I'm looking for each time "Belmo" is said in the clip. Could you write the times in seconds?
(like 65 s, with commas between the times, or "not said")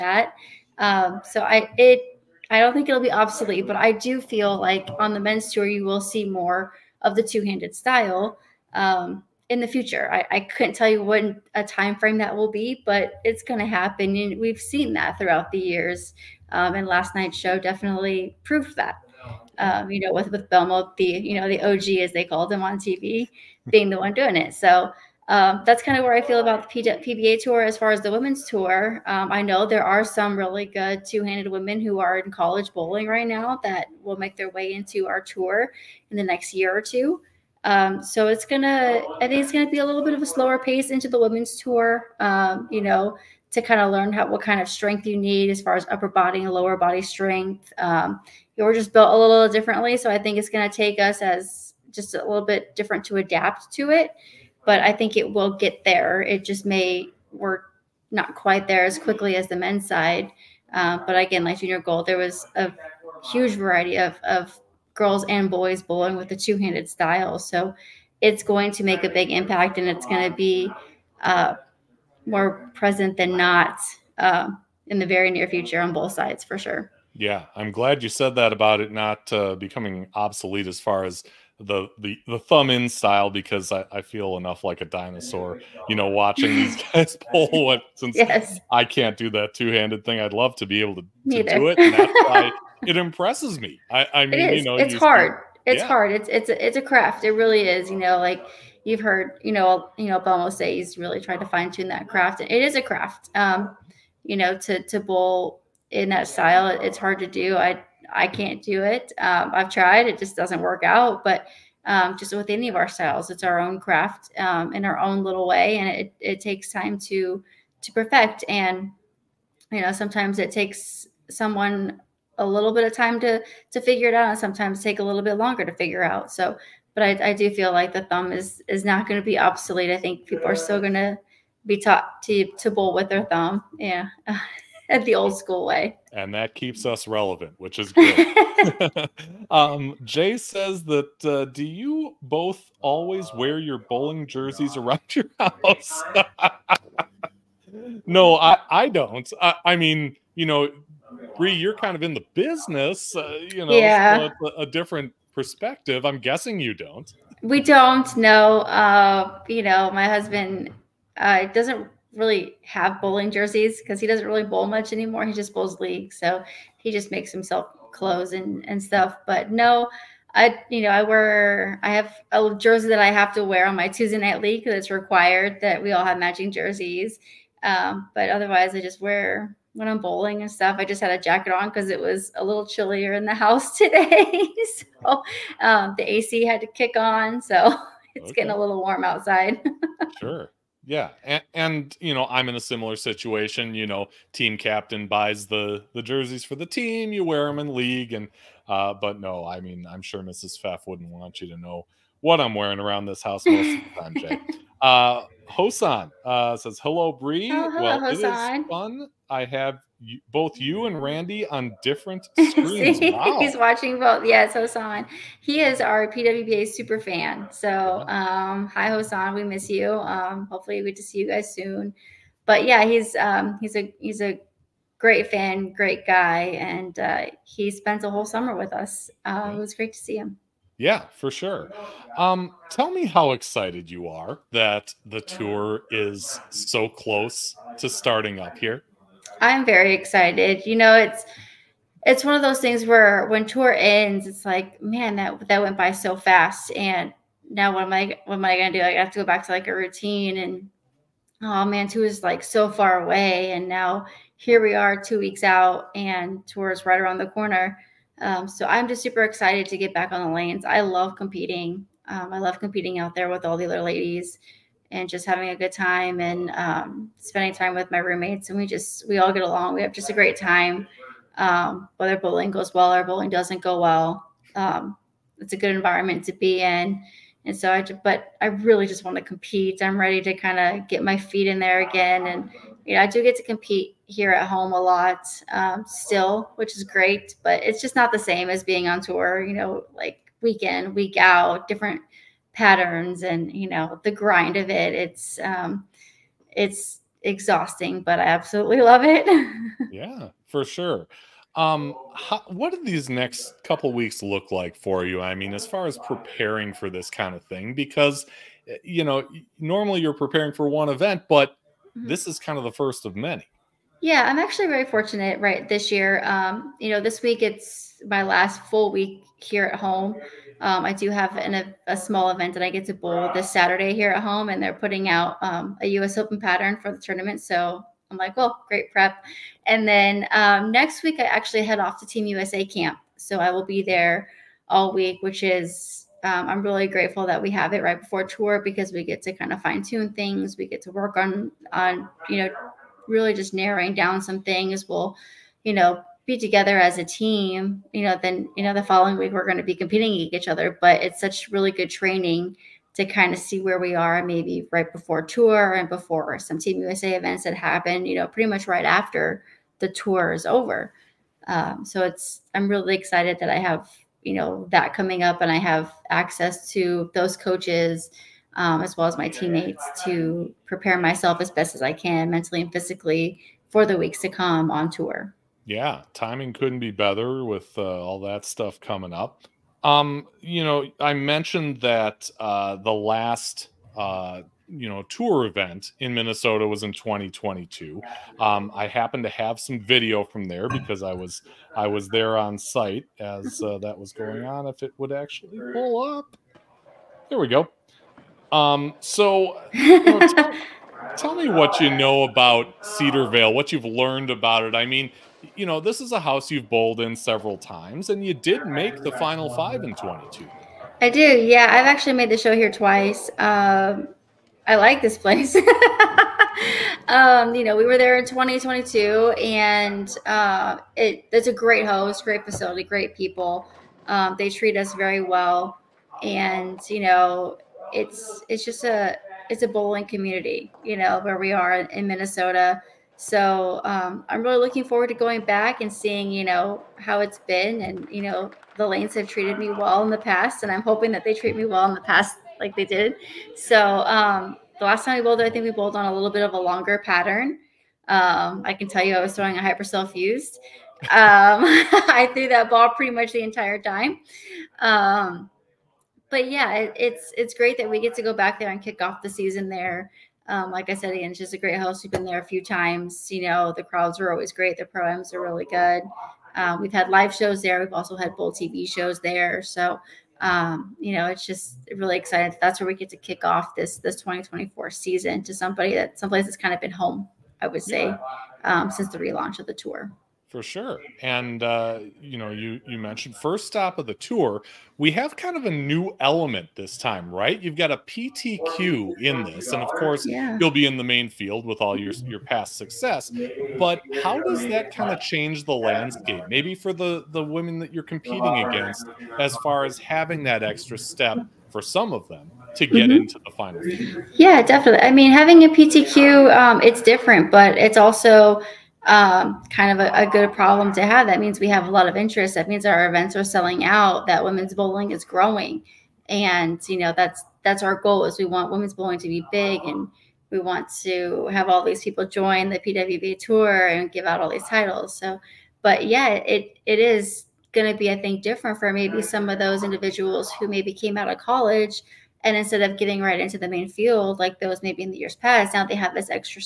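20 s, 100 s.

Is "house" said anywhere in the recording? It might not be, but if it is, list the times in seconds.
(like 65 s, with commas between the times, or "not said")
145 s, 183 s, 203 s, 406 s.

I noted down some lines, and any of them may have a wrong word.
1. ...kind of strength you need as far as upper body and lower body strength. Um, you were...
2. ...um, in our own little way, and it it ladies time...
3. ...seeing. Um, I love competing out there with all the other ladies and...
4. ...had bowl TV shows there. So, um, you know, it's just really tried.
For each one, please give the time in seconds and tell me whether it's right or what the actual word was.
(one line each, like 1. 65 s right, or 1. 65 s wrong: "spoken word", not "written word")
1. 44 s right
2. 114 s wrong: "takes", not "ladies"
3. 261 s wrong: "competing", not "seeing"
4. 468 s wrong: "excited", not "tried".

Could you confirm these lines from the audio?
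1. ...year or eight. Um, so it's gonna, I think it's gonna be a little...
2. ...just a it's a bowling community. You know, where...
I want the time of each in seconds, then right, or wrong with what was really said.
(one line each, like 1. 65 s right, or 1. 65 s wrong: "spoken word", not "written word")
1. 36 s wrong: "two", not "eight"
2. 428 s right.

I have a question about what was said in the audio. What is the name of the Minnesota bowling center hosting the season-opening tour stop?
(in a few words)
Cedarvale.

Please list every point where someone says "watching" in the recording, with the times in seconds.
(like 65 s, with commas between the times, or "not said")
86 s, 213 s.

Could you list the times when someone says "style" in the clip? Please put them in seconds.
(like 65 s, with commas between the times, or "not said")
7 s, 66 s, 82 s, 106 s, 112 s.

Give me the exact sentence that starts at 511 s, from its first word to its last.
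That means we have a lot of interest.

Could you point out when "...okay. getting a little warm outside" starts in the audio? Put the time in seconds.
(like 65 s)
188 s.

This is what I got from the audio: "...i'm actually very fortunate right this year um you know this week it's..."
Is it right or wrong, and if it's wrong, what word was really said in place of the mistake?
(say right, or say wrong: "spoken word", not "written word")
right.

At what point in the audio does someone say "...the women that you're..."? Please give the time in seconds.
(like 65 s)
497 s.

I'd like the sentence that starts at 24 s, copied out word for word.
So um, that's kind of where I feel about the PBA tour.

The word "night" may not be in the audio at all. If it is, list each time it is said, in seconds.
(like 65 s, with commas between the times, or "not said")
17 s, 174 s.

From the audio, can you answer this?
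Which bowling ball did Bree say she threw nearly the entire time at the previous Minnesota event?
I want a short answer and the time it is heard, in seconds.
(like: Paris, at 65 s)
Hyper Cell Fused, at 449 s.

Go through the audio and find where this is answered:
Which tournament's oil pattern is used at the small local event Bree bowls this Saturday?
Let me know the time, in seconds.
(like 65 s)
325 s.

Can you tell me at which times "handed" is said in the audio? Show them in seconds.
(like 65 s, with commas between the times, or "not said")
7 s, 31 s, 66 s, 89 s.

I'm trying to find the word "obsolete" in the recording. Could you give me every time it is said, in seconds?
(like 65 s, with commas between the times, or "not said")
3 s, 80 s, 129 s.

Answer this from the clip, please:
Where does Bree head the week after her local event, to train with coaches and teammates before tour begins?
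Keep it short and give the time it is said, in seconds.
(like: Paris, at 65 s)
Team USA camp, at 332 s.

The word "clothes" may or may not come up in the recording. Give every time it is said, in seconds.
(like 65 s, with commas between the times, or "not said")
167 s.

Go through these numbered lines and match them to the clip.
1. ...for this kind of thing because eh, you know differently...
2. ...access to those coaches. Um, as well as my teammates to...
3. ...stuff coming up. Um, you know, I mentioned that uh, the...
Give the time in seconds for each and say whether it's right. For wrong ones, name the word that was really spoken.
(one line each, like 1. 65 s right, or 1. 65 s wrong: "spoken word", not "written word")
1. 306 s wrong: "normally", not "differently"
2. 366 s right
3. 378 s right.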